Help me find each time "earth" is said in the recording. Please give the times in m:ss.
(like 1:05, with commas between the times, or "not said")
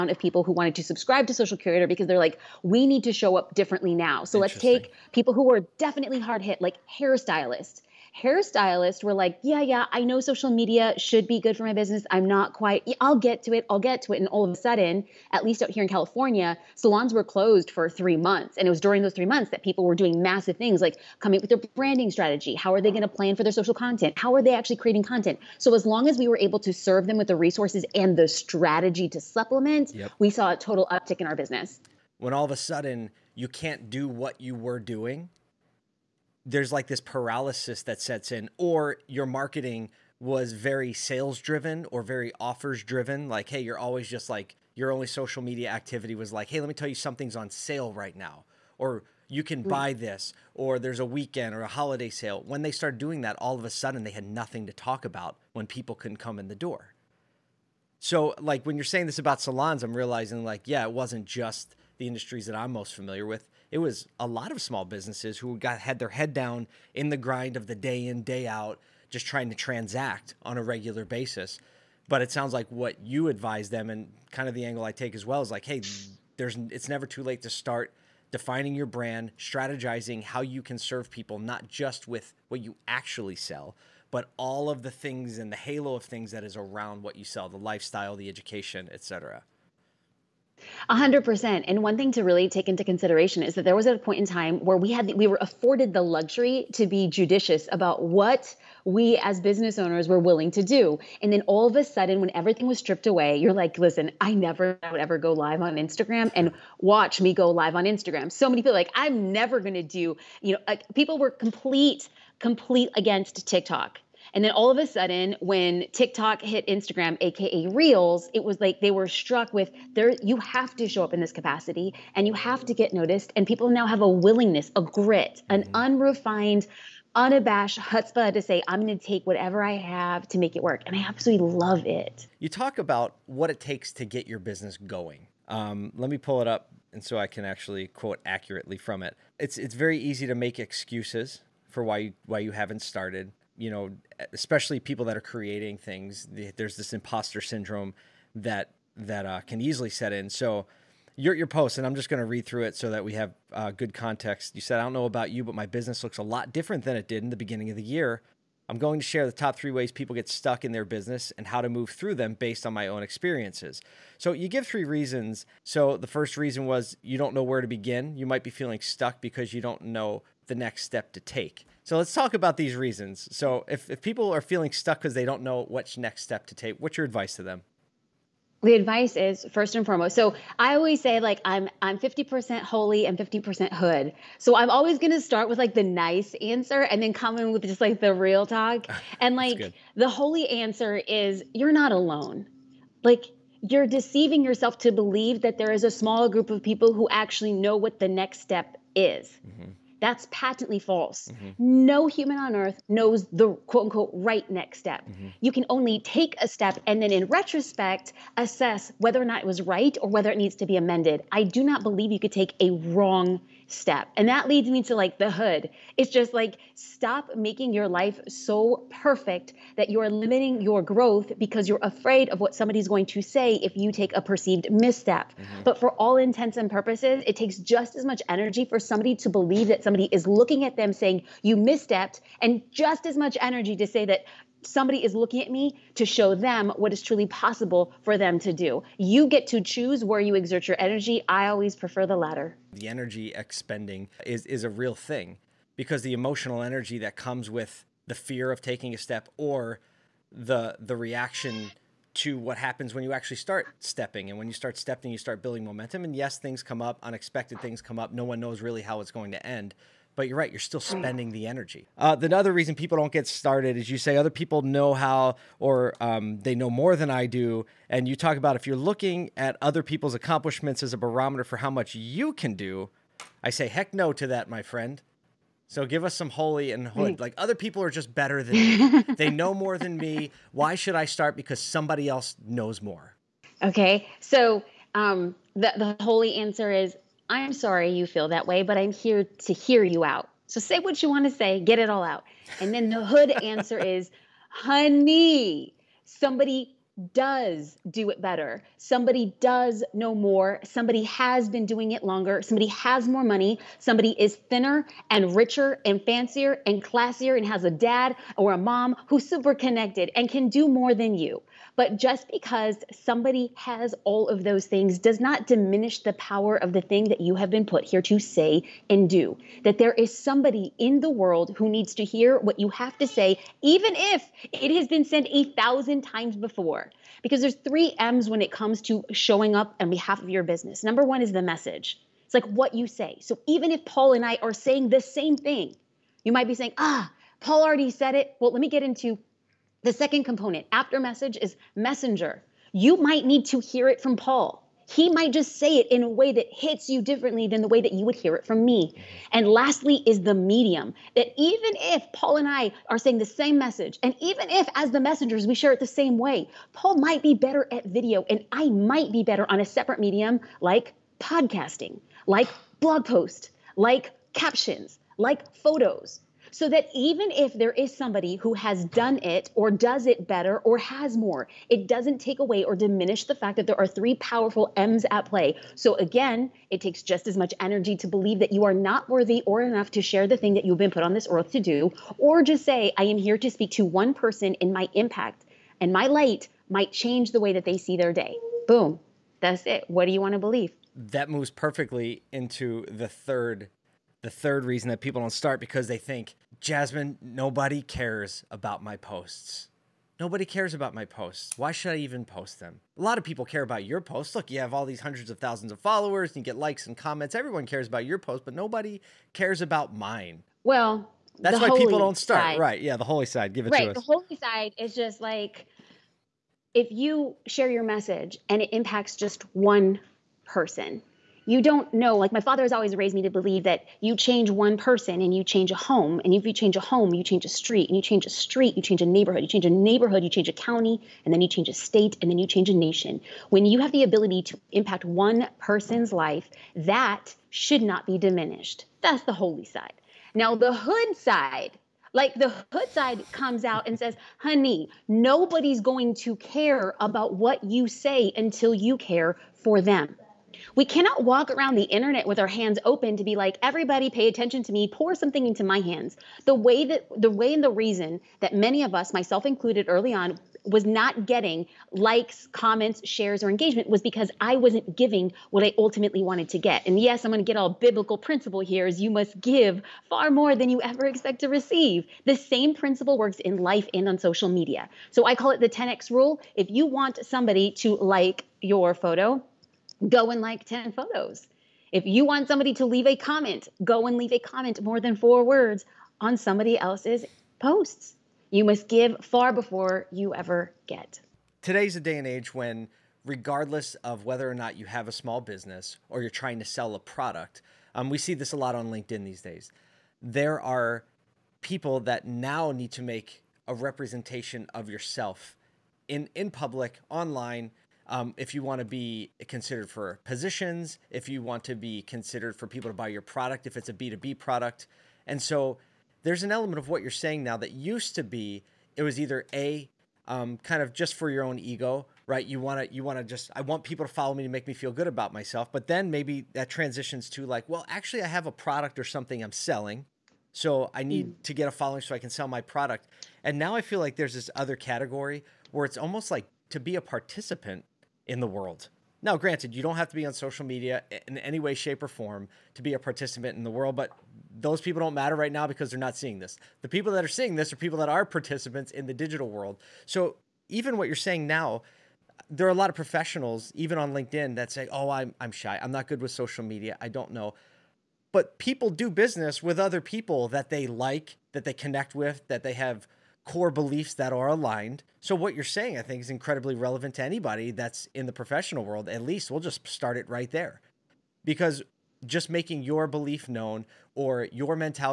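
3:22, 6:21.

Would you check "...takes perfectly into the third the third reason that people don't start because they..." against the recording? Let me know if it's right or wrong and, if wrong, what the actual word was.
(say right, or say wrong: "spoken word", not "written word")
wrong: "moves", not "takes".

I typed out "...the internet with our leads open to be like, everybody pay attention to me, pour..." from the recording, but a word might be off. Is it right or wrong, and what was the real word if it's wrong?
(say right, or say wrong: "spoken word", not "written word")
wrong: "hands", not "leads".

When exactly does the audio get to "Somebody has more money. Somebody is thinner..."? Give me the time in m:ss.
5:02.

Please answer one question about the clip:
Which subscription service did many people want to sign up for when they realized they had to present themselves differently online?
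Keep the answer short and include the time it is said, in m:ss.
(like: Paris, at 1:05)
Social Curator, at 0:01.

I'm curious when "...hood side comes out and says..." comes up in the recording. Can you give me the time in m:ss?
7:22.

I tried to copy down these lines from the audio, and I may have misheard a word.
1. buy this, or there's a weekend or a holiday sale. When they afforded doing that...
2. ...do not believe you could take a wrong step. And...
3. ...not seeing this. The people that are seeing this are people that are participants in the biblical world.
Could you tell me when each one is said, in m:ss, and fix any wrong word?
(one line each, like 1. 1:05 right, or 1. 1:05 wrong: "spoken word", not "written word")
1. 0:49 wrong: "started", not "afforded"
2. 3:31 right
3. 9:05 wrong: "digital", not "biblical".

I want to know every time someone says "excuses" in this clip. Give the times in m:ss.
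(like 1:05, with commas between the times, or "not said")
2:20.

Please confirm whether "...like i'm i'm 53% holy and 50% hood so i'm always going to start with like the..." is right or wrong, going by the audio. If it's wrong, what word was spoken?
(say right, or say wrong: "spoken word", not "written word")
wrong: "50", not "53".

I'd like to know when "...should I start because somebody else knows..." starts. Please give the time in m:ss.
4:40.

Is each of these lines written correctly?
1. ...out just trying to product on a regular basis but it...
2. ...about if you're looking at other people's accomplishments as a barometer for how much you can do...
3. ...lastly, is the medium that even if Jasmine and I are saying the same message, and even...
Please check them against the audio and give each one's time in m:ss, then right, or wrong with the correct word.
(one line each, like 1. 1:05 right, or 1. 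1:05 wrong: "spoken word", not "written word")
1. 1:08 wrong: "transact", not "product"
2. 4:28 right
3. 5:49 wrong: "Paul", not "Jasmine".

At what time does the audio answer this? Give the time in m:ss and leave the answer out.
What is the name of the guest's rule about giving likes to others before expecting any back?
7:55.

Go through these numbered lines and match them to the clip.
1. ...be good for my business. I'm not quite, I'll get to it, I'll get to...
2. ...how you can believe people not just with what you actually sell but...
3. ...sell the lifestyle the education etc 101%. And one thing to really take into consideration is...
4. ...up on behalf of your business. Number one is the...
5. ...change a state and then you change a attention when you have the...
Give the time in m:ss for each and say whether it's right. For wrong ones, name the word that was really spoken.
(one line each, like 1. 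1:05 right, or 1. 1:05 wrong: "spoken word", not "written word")
1. 0:11 right
2. 1:20 wrong: "serve", not "believe"
3. 1:27 wrong: "100", not "101"
4. 5:29 right
5. 7:11 wrong: "nation", not "attention".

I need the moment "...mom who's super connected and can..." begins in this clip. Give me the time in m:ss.
5:08.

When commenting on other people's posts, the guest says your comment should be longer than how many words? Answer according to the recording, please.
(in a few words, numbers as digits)
4.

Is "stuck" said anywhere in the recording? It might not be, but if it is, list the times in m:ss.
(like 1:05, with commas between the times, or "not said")
2:40, 2:48, 2:54.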